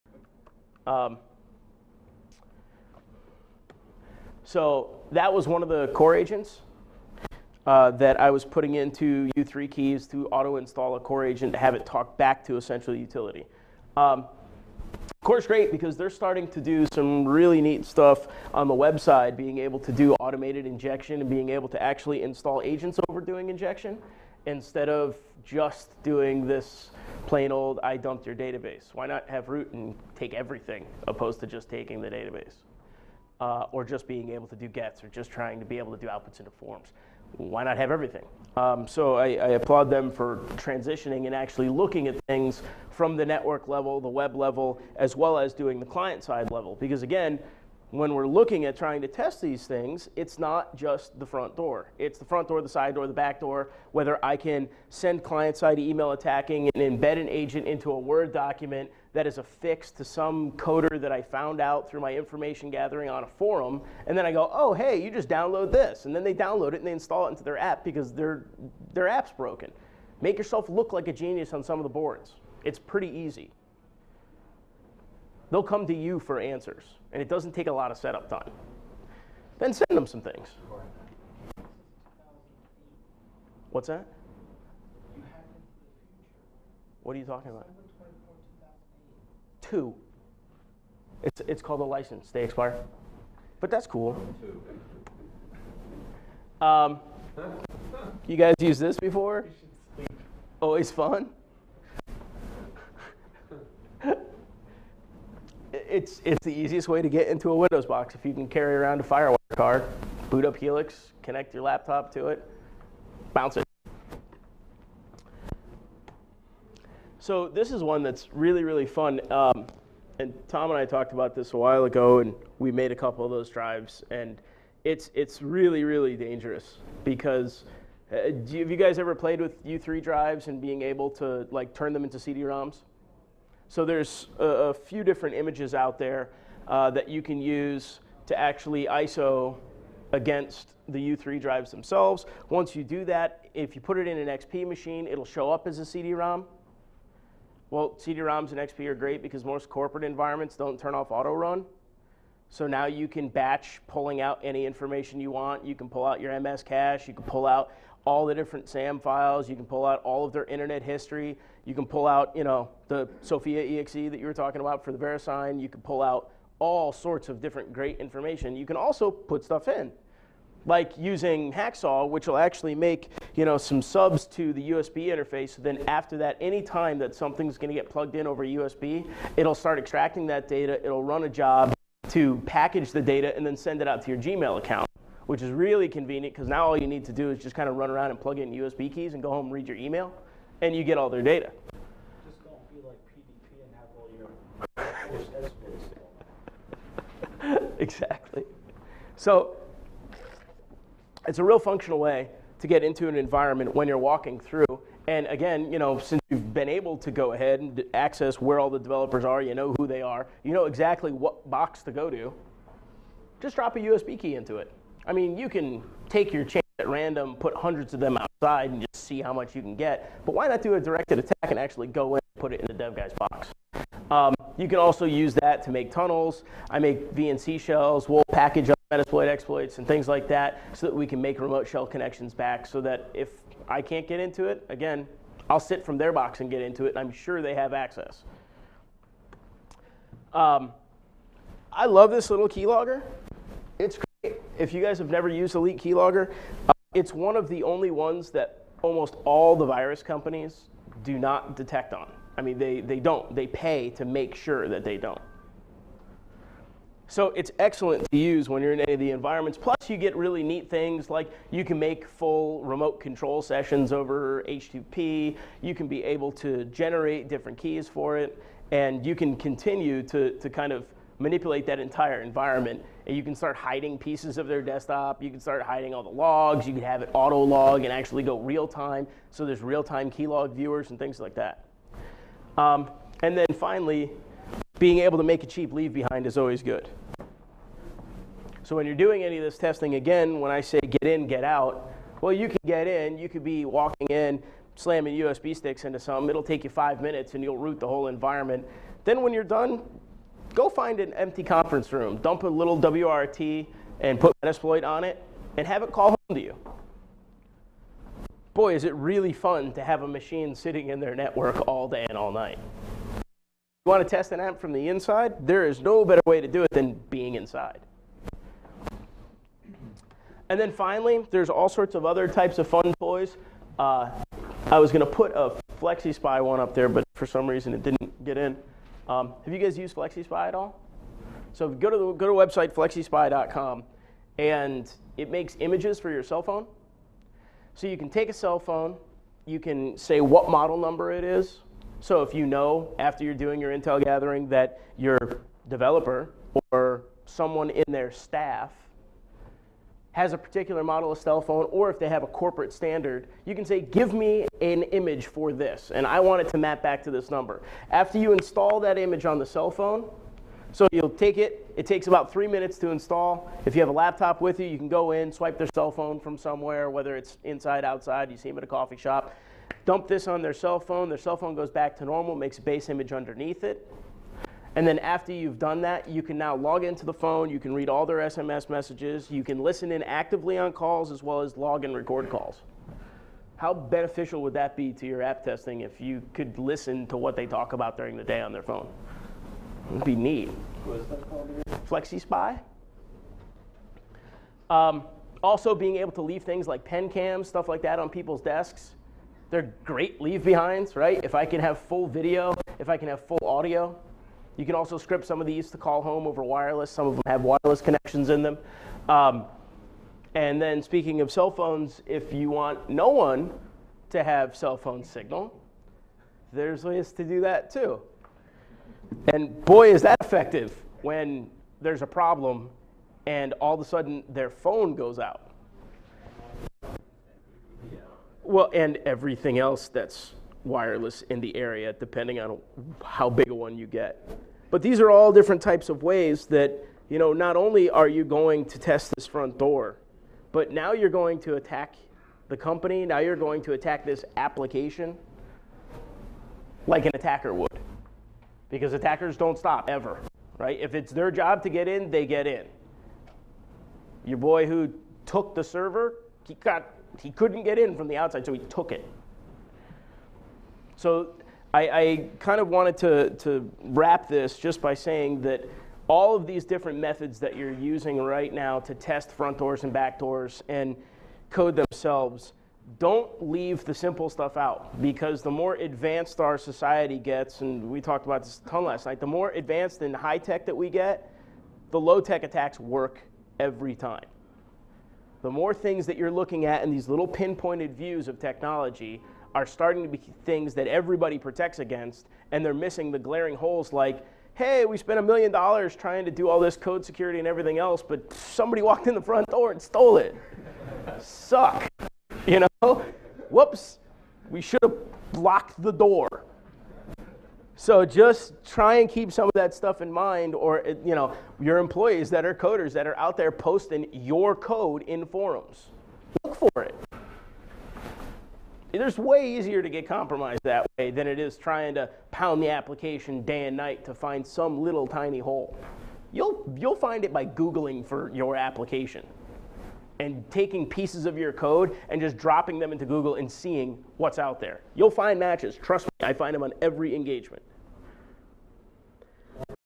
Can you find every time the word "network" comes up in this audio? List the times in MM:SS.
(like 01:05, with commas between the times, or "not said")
00:43, 05:11.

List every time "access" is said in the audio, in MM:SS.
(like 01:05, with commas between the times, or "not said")
03:27, 03:57.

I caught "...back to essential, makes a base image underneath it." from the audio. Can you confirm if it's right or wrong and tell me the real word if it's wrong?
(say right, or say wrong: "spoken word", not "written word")
wrong: "normal", not "essential".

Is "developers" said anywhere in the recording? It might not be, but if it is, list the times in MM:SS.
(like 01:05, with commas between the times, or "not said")
03:28, 05:45.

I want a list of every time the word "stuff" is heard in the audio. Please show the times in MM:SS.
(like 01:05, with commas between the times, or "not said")
00:17, 02:49, 06:37, 07:54, 08:29.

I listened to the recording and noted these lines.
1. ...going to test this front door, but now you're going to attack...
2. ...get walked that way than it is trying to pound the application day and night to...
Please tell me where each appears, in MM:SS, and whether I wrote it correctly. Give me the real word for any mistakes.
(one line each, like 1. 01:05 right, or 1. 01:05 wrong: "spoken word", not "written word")
1. 07:18 right
2. 08:39 wrong: "compromised", not "walked".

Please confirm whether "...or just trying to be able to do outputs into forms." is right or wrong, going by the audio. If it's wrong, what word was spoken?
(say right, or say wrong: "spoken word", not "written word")
right.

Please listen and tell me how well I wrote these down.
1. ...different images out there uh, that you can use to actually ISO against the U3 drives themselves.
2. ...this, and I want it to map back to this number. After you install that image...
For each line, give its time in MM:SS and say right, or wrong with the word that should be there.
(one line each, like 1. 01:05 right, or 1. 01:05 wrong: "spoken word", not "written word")
1. 02:15 right
2. 05:55 right.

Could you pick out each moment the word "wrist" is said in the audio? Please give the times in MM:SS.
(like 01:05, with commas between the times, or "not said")
not said.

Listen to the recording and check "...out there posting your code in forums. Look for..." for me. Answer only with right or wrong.
right.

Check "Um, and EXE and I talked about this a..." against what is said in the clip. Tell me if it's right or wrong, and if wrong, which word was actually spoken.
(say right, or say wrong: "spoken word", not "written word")
wrong: "Tom", not "EXE".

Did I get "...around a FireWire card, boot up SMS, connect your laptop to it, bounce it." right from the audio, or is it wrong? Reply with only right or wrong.
wrong.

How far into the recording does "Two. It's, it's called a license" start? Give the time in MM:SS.
01:29.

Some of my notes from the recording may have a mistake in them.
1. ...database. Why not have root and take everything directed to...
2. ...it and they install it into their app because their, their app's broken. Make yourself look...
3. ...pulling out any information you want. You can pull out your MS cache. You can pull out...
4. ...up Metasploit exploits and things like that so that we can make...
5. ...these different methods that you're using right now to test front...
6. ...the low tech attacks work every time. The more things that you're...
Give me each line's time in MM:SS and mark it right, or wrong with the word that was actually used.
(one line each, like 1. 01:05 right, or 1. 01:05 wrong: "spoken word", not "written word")
1. 00:28 wrong: "opposed", not "directed"
2. 01:06 right
3. 02:33 right
4. 03:48 right
5. 07:46 right
6. 08:01 right.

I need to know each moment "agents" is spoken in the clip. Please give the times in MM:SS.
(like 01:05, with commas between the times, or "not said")
00:06, 00:11, 00:22, 00:57.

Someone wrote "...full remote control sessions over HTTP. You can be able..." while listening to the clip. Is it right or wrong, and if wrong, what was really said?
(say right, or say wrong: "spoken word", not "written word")
right.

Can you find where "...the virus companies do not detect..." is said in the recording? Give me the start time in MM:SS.
04:09.